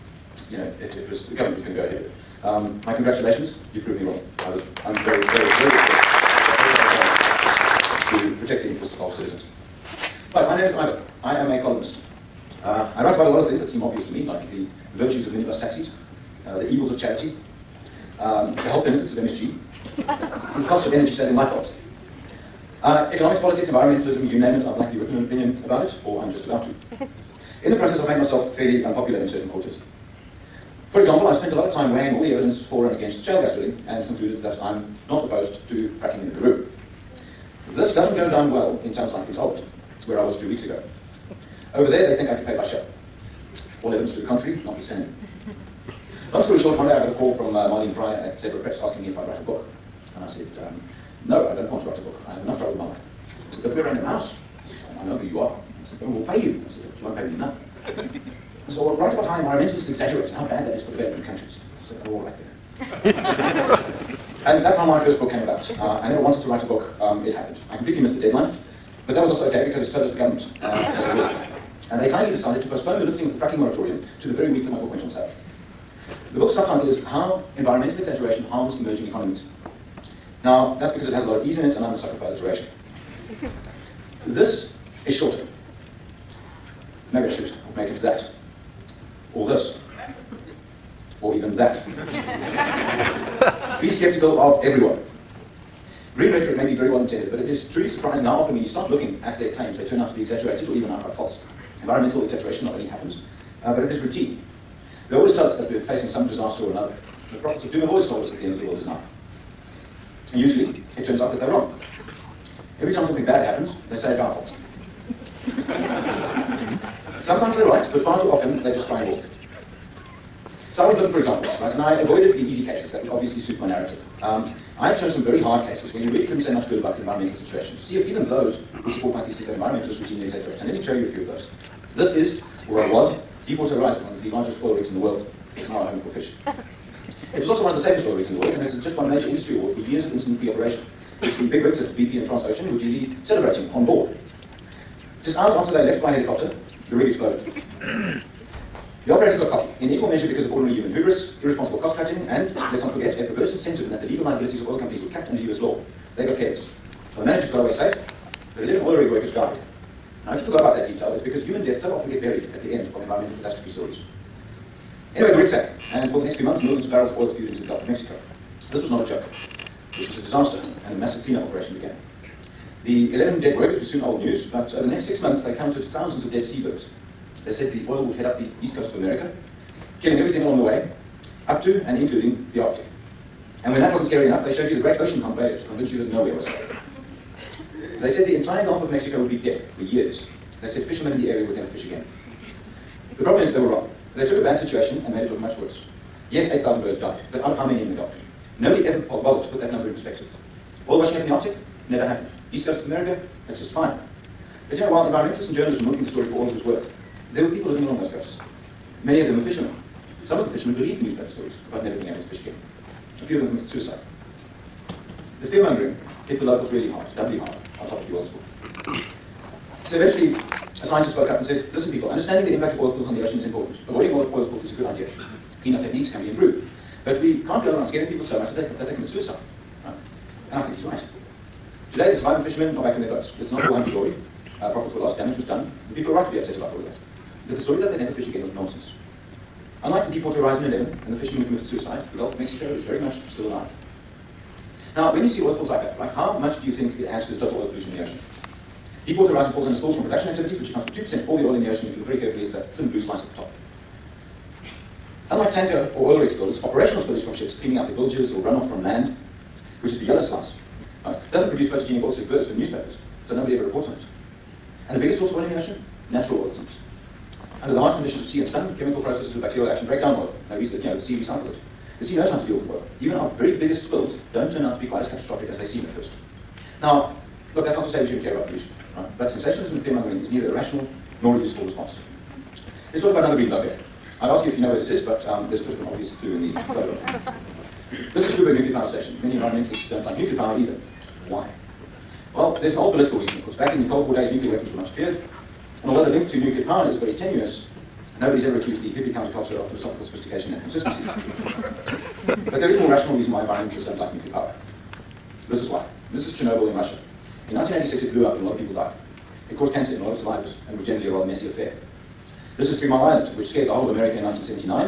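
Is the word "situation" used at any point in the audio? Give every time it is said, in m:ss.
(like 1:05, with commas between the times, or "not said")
2:07, 3:14.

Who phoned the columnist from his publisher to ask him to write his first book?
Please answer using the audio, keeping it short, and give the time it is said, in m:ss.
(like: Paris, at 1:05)
Marlene Fryer, at 0:47.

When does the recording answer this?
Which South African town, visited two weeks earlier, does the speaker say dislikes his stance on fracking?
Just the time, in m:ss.
0:39.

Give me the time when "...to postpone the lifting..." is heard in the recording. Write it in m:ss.
1:12.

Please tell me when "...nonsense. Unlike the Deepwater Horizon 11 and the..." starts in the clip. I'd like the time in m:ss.
3:58.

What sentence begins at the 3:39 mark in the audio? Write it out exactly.
So eventually, a scientist spoke up and said, listen people, understanding the impact of oil spills on the ocean is important.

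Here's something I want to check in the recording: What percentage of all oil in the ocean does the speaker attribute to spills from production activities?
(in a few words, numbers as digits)
2%.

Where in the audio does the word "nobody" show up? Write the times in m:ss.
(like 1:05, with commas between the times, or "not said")
3:18, 4:23, 4:58.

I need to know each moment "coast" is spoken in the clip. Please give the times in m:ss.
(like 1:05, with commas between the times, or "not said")
2:58, 3:22, 3:28.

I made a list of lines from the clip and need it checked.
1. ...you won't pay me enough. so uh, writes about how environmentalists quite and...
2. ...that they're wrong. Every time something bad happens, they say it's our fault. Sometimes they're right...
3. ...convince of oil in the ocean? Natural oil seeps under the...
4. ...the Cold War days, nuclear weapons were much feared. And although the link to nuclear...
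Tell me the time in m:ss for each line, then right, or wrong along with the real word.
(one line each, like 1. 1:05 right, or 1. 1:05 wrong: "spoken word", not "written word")
1. 0:57 wrong: "exaggerate", not "quite"
2. 1:51 right
3. 4:25 wrong: "source", not "convince"
4. 4:53 right.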